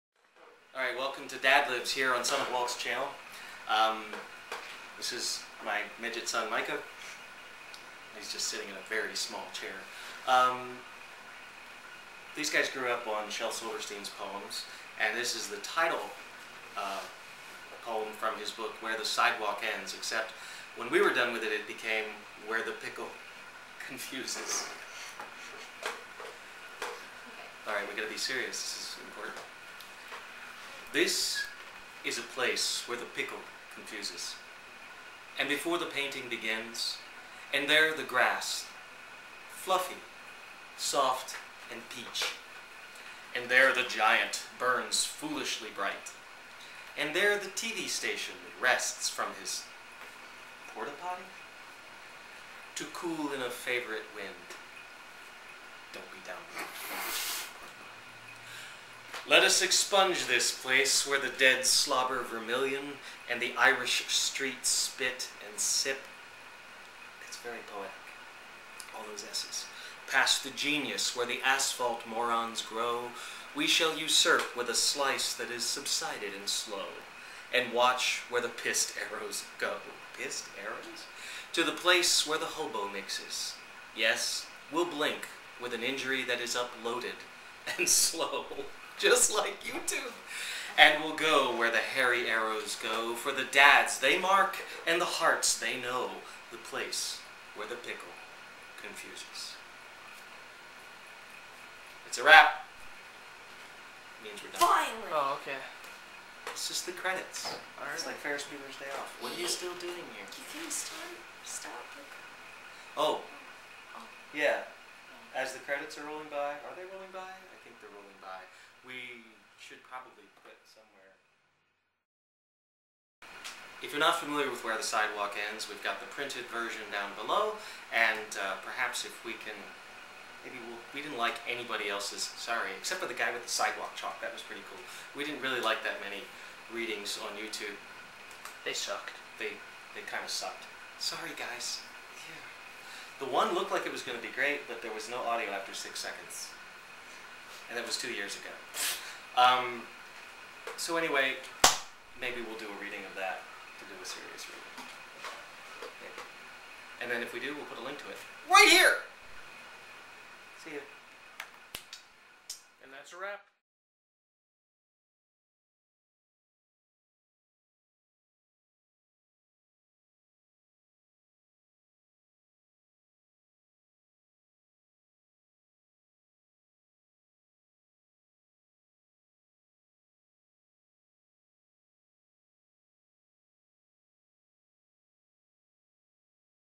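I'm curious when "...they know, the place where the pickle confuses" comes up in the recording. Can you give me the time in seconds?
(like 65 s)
95 s.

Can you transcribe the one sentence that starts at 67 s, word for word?
It's very poetic, all those S's.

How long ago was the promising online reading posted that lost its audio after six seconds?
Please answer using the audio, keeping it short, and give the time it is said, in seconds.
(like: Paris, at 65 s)
2 years, at 147 s.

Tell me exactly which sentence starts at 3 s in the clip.
Um, this is my midget son, Micah.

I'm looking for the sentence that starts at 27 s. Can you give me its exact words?
All right, we got to be serious.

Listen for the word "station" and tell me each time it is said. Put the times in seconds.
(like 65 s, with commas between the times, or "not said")
47 s.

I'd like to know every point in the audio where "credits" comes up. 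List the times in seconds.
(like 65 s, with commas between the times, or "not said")
106 s, 115 s.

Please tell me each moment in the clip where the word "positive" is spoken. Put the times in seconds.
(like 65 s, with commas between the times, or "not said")
not said.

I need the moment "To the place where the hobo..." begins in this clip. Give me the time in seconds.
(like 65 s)
81 s.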